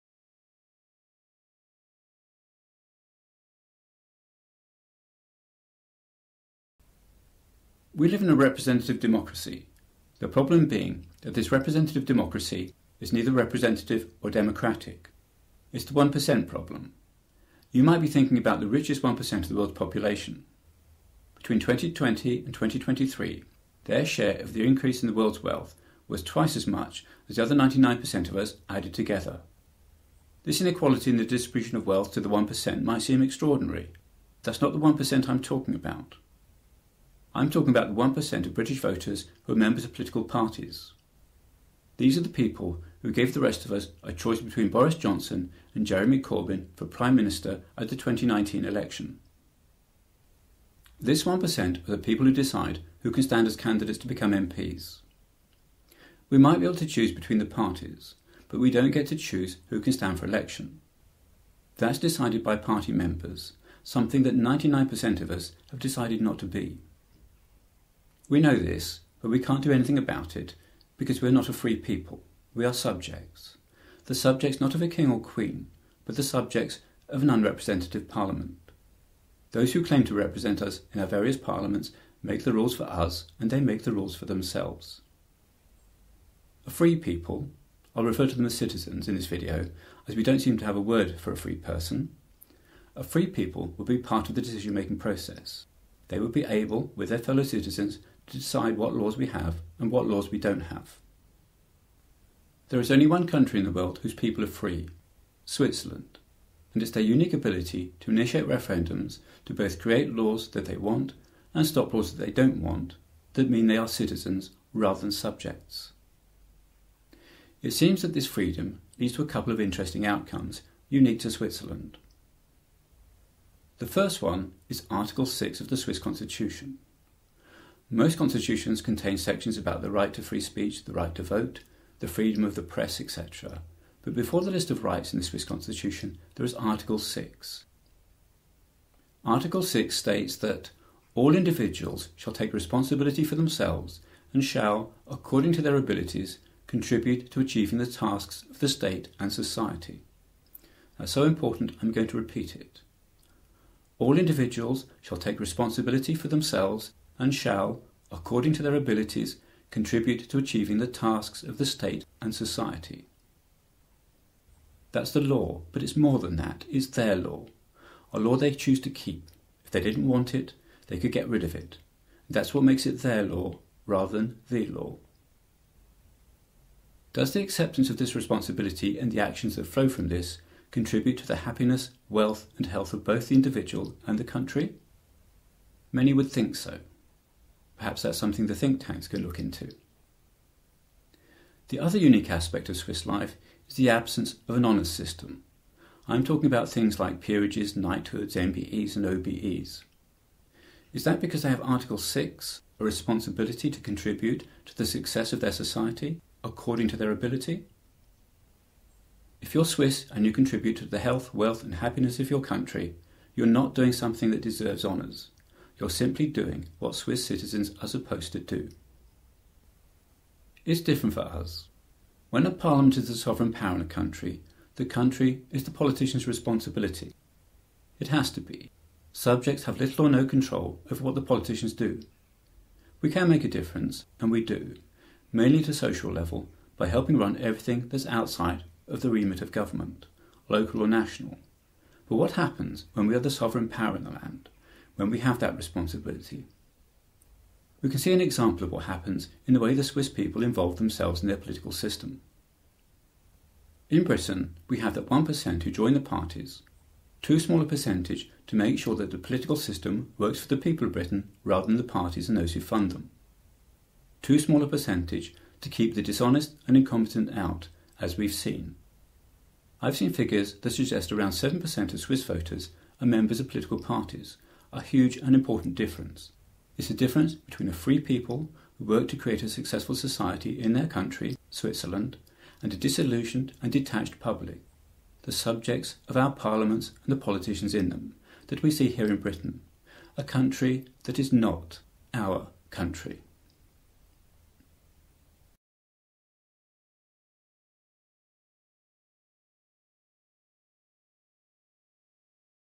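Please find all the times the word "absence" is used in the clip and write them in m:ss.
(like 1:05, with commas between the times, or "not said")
3:13.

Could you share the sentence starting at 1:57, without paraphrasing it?
It seems that this freedom leads to a couple of interesting outcomes unique to Switzerland.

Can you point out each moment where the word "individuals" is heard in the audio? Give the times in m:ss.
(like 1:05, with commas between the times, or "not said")
2:21, 2:34, 3:03.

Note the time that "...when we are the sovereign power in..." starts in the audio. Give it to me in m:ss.
4:02.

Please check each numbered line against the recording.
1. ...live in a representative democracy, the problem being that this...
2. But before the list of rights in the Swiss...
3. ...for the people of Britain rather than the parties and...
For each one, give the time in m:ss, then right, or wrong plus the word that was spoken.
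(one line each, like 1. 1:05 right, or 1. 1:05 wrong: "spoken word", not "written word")
1. 0:08 right
2. 2:14 right
3. 4:20 right.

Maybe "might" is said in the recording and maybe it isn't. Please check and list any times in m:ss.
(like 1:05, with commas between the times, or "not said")
0:17, 0:32, 0:56.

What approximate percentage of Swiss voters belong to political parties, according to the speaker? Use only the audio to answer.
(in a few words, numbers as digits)
7%.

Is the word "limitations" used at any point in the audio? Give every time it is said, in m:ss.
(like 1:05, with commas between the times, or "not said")
not said.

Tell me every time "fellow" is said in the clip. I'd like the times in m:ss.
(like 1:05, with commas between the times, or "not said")
1:37.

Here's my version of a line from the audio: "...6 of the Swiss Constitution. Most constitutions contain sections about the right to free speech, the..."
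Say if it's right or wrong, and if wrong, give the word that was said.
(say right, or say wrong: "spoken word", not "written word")
right.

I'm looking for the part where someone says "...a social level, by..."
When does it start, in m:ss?
3:55.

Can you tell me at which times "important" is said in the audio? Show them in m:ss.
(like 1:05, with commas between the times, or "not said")
2:31, 4:35.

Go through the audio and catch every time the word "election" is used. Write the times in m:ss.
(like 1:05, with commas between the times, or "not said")
0:48, 1:00.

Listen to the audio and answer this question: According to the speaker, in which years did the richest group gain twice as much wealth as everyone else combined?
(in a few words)
2020 to 2023.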